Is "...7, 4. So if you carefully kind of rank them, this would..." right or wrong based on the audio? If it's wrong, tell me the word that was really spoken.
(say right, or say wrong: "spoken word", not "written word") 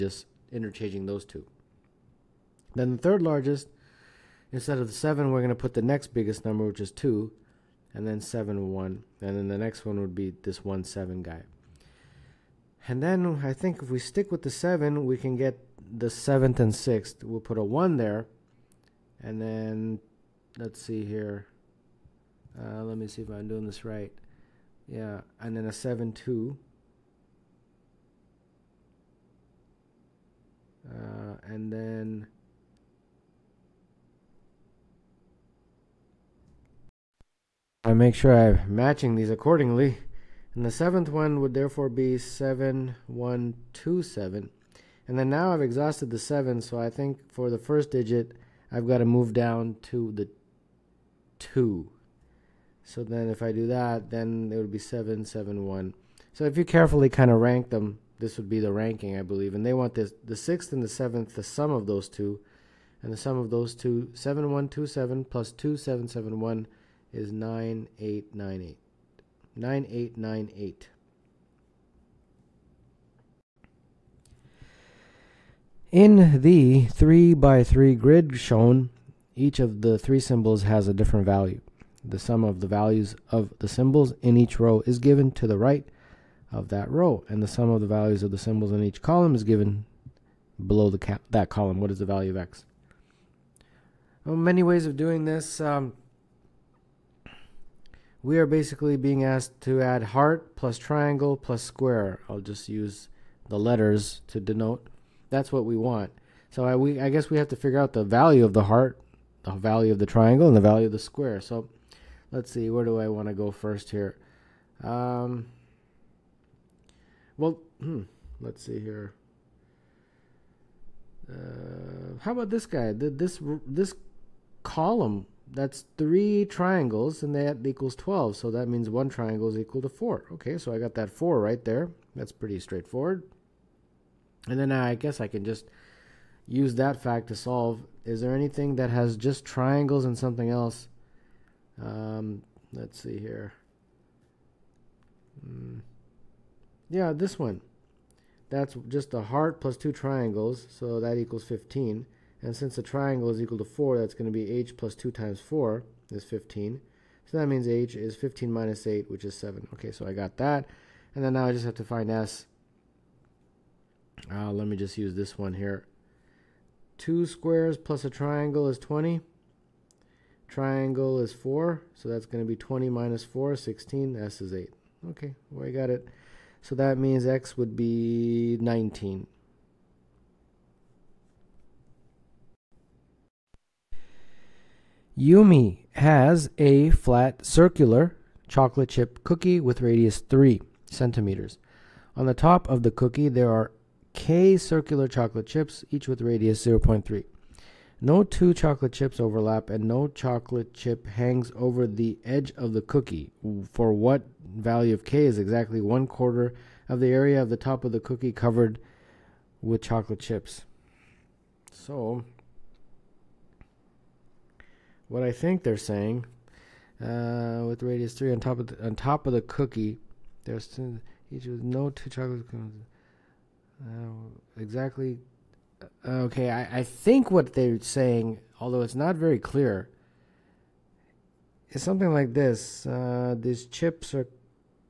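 wrong: "1", not "4".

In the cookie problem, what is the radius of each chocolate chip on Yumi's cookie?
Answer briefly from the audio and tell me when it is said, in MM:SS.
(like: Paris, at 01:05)
0.3, at 03:16.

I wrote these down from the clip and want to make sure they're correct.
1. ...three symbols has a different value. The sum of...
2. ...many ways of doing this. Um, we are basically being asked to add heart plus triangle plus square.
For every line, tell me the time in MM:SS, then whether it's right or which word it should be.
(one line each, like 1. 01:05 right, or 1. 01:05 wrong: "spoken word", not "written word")
1. 01:19 right
2. 01:34 right.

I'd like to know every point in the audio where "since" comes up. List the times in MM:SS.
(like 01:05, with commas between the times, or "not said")
02:32.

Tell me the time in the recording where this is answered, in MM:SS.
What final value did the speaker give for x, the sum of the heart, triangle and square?
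02:57.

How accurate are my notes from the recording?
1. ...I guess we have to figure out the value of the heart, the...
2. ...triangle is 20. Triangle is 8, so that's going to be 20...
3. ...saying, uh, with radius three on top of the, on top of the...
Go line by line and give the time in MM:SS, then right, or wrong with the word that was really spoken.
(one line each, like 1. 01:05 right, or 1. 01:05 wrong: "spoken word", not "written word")
1. 01:46 right
2. 02:48 wrong: "4", not "8"
3. 03:35 right.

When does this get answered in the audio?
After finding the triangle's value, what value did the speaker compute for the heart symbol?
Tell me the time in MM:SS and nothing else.
02:37.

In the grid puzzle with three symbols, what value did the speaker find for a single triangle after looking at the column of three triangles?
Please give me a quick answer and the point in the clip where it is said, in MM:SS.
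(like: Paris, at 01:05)
4, at 02:08.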